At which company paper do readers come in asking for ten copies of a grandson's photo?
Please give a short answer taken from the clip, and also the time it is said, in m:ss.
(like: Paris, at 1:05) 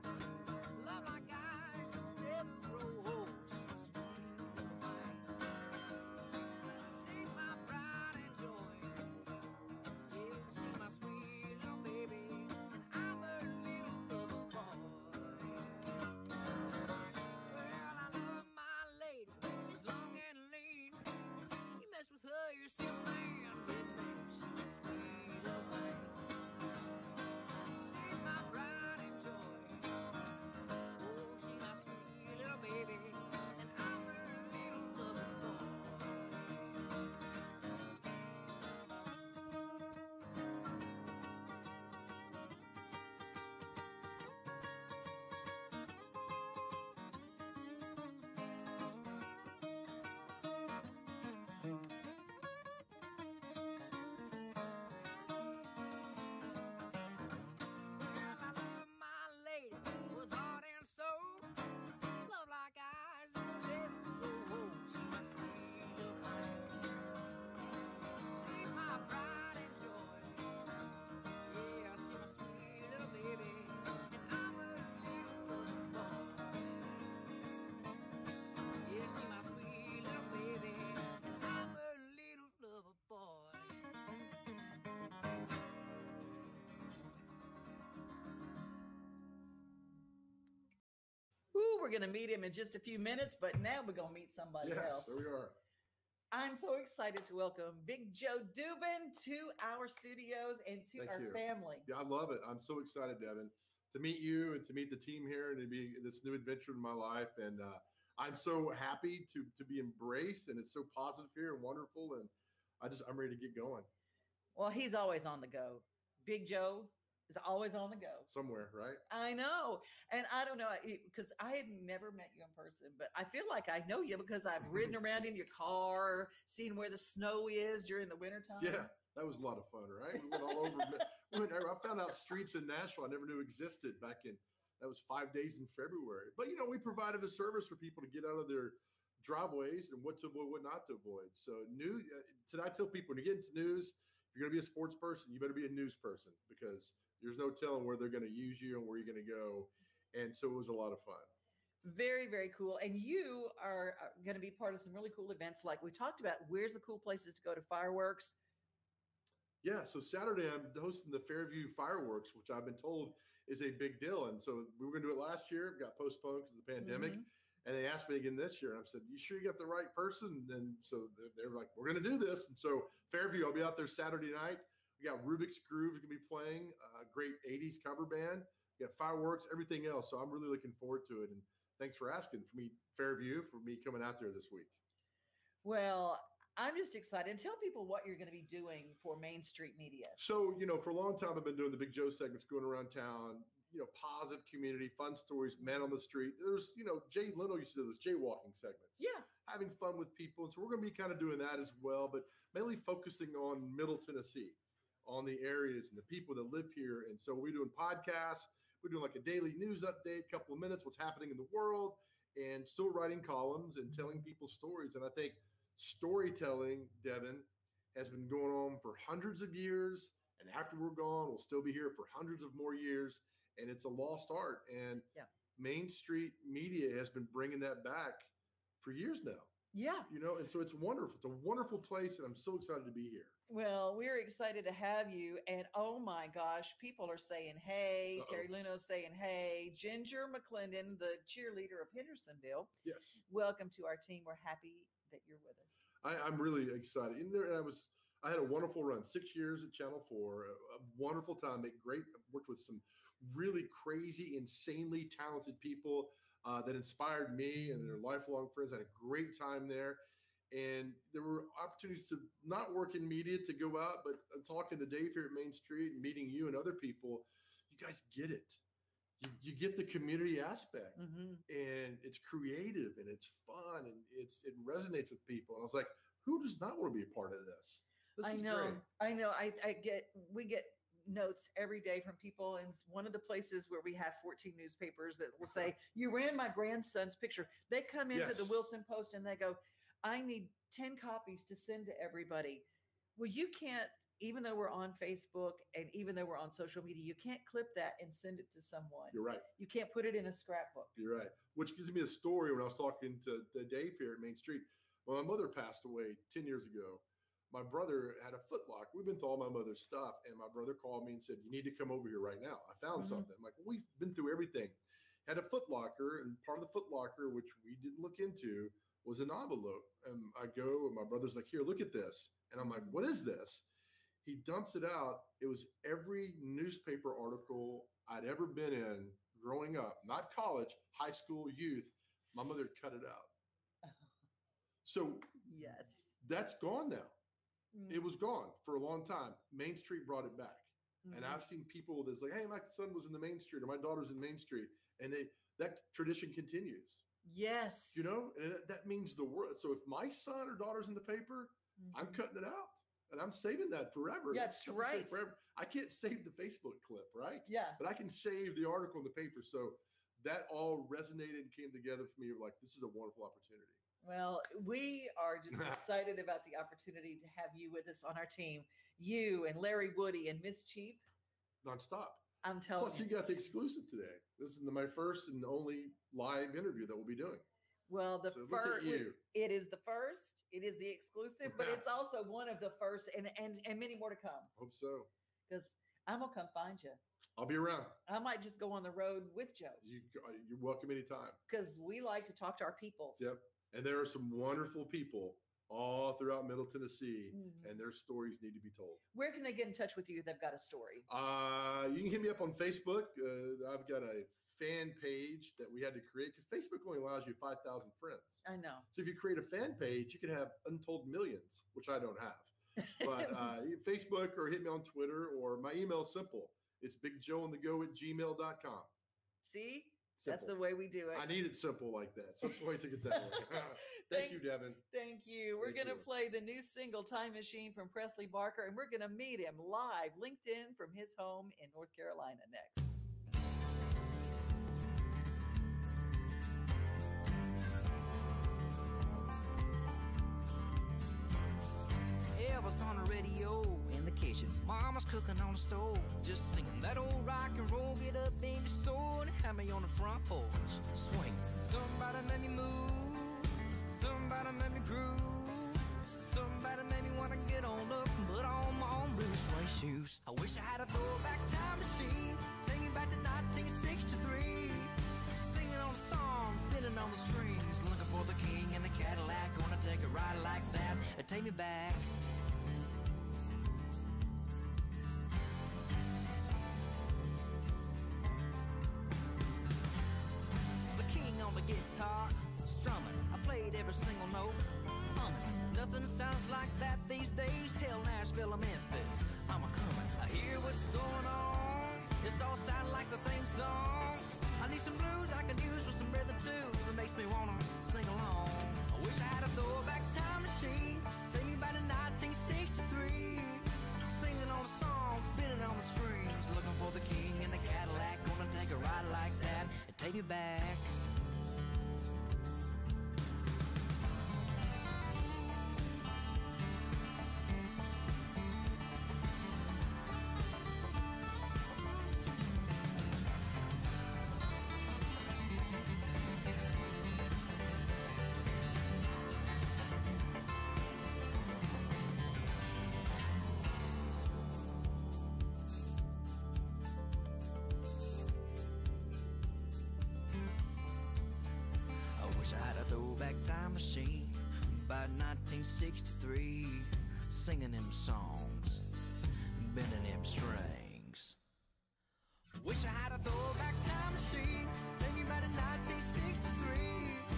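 Wilson Post, at 4:48.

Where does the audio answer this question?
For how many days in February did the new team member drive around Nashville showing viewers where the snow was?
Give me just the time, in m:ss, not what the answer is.
2:15.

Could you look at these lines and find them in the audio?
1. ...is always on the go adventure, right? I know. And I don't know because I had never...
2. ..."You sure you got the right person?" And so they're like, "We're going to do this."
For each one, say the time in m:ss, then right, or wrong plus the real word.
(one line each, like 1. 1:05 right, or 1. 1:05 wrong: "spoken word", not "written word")
1. 1:57 wrong: "somewhere", not "adventure"
2. 2:49 right.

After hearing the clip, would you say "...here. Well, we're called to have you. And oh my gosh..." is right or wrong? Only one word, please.
wrong.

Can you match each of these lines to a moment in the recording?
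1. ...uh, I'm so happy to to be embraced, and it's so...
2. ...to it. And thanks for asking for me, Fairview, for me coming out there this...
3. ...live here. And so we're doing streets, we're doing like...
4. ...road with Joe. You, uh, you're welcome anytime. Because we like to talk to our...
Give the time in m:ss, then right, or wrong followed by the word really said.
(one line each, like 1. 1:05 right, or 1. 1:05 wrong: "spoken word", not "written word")
1. 1:47 right
2. 3:01 right
3. 3:26 wrong: "podcasts", not "streets"
4. 6:28 right.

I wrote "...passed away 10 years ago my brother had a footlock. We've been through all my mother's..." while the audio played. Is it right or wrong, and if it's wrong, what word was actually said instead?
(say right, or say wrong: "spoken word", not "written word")
right.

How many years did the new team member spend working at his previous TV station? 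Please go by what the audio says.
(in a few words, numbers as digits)
6.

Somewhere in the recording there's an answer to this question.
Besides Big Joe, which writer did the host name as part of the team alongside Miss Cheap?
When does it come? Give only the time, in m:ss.
6:09.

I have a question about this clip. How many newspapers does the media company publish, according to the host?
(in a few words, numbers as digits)
14.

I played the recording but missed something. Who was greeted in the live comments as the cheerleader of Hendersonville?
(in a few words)
Ginger McClendon.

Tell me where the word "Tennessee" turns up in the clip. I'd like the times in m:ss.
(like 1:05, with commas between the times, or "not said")
3:23, 6:36.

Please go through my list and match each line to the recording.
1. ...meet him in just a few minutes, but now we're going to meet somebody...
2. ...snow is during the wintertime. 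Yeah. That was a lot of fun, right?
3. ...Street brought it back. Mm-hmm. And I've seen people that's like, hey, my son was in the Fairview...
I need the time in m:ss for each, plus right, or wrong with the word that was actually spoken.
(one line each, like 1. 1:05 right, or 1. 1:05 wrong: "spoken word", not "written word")
1. 1:32 right
2. 2:06 right
3. 5:39 wrong: "Main", not "Fairview".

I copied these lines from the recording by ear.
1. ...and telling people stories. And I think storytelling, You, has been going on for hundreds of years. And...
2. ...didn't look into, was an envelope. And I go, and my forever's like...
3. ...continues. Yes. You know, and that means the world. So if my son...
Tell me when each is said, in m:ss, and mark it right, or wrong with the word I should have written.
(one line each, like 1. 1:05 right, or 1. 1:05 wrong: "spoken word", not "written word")
1. 3:33 wrong: "Devon", not "You"
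2. 5:17 wrong: "brother", not "forever"
3. 5:46 right.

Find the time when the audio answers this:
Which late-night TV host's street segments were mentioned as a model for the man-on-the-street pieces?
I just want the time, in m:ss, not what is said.
3:17.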